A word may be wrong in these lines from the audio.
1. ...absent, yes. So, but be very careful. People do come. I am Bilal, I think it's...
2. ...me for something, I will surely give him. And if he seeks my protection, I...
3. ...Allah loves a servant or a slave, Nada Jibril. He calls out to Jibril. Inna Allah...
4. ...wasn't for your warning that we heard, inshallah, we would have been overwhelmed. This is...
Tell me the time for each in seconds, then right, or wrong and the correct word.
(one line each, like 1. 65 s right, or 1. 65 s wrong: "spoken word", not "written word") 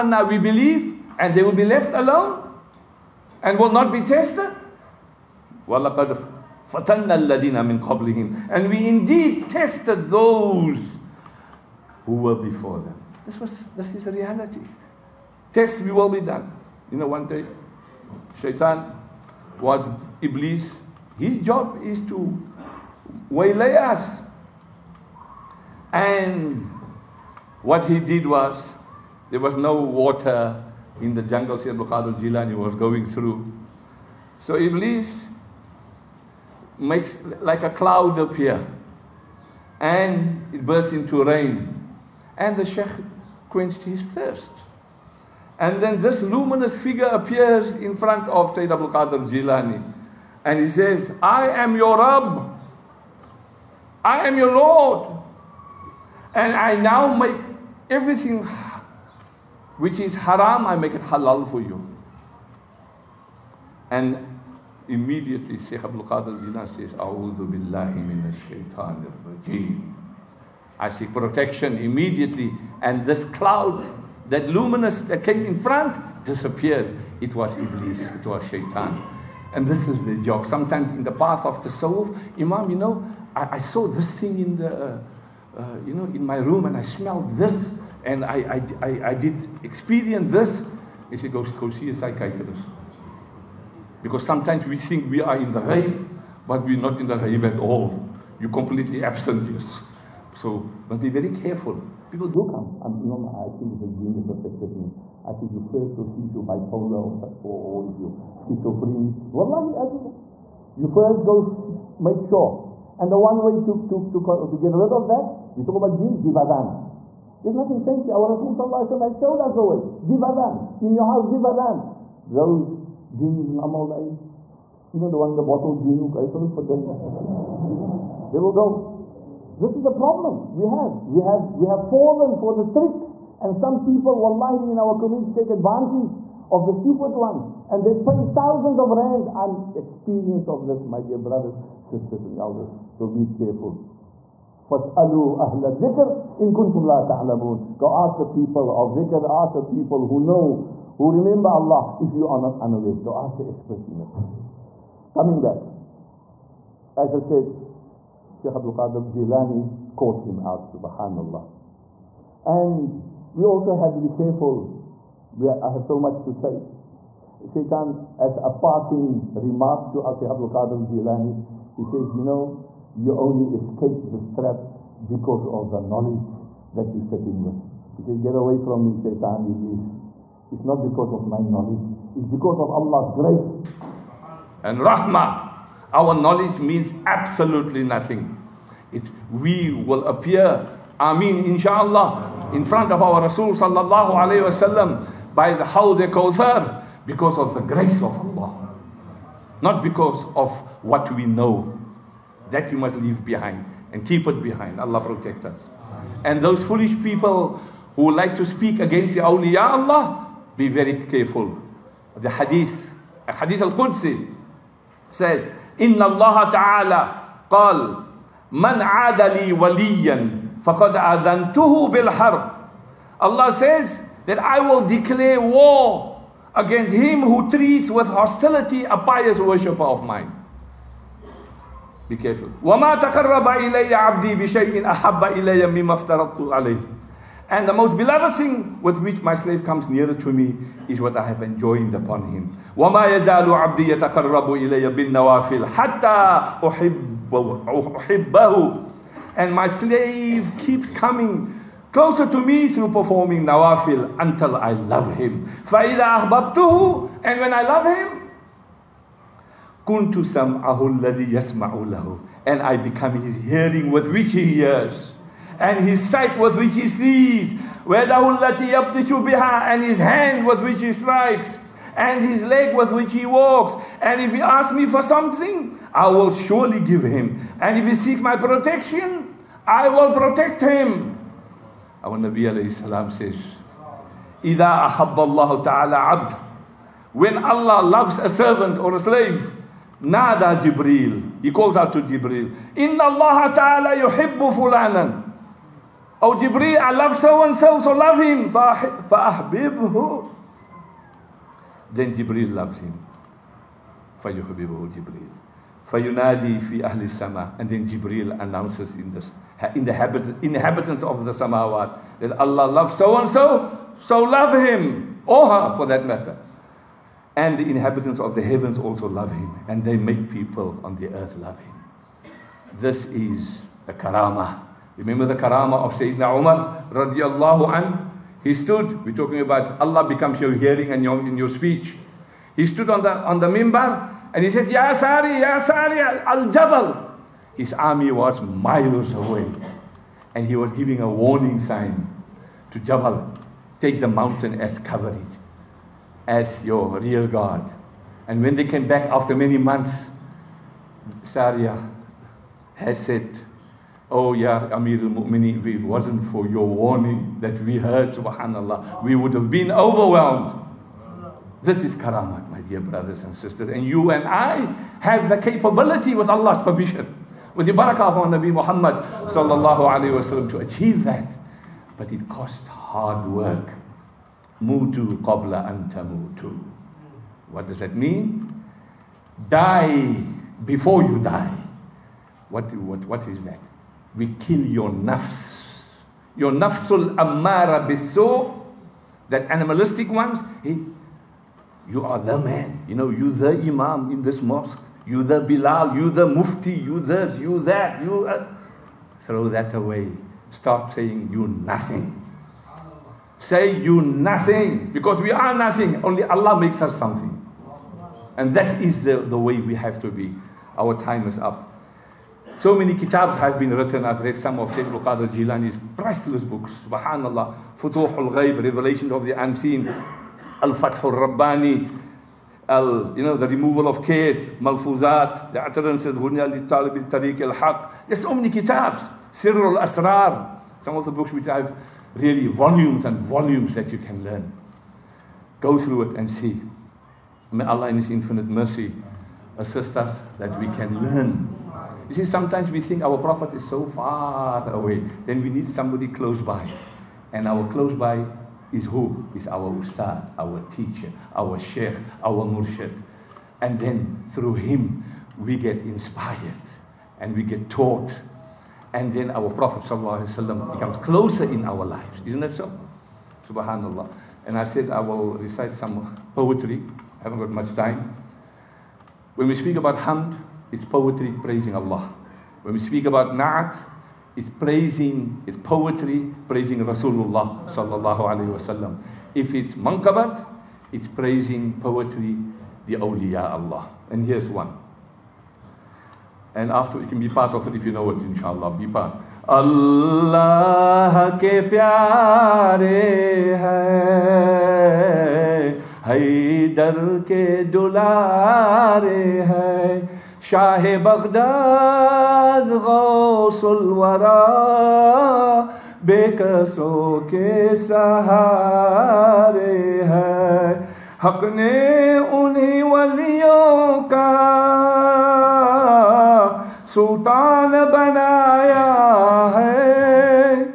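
1. 99 s wrong: "Imam", not "Bilal"
2. 274 s right
3. 287 s right
4. 355 s wrong: "subhanAllah", not "inshallah".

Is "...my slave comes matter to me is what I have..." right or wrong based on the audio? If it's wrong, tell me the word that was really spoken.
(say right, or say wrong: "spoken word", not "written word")
wrong: "nearer", not "matter".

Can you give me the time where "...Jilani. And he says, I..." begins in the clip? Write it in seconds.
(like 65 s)
49 s.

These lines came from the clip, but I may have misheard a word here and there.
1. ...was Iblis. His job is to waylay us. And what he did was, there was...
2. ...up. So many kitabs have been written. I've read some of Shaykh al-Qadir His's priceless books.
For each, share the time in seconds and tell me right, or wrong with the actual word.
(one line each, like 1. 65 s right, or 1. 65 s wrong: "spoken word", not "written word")
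1. 19 s right
2. 411 s wrong: "Jilani", not "His".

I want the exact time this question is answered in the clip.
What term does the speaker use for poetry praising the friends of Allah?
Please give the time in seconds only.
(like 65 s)
479 s.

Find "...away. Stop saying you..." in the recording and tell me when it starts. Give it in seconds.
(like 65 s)
399 s.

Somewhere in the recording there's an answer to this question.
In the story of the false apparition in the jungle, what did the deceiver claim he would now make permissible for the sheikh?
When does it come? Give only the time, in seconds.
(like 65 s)
57 s.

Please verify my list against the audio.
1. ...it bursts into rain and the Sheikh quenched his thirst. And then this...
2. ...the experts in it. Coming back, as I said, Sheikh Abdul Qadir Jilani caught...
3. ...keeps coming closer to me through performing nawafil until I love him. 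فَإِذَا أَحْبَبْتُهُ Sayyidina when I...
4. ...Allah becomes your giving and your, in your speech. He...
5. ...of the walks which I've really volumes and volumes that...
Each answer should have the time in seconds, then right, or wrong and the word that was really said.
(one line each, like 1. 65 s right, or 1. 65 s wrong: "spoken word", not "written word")
1. 40 s right
2. 153 s right
3. 250 s wrong: "And", not "Sayyidina"
4. 329 s wrong: "hearing", not "giving"
5. 430 s wrong: "books", not "walks".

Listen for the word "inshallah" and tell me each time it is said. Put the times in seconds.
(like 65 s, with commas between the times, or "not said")
191 s, 488 s.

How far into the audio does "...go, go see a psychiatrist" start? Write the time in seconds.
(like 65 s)
91 s.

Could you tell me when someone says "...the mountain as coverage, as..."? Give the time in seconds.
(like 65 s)
344 s.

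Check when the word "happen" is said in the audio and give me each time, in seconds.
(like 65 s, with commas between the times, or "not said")
not said.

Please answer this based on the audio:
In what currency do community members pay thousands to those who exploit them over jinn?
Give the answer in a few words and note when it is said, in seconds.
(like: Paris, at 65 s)
Rands, at 138 s.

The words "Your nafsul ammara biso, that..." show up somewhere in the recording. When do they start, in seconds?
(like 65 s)
386 s.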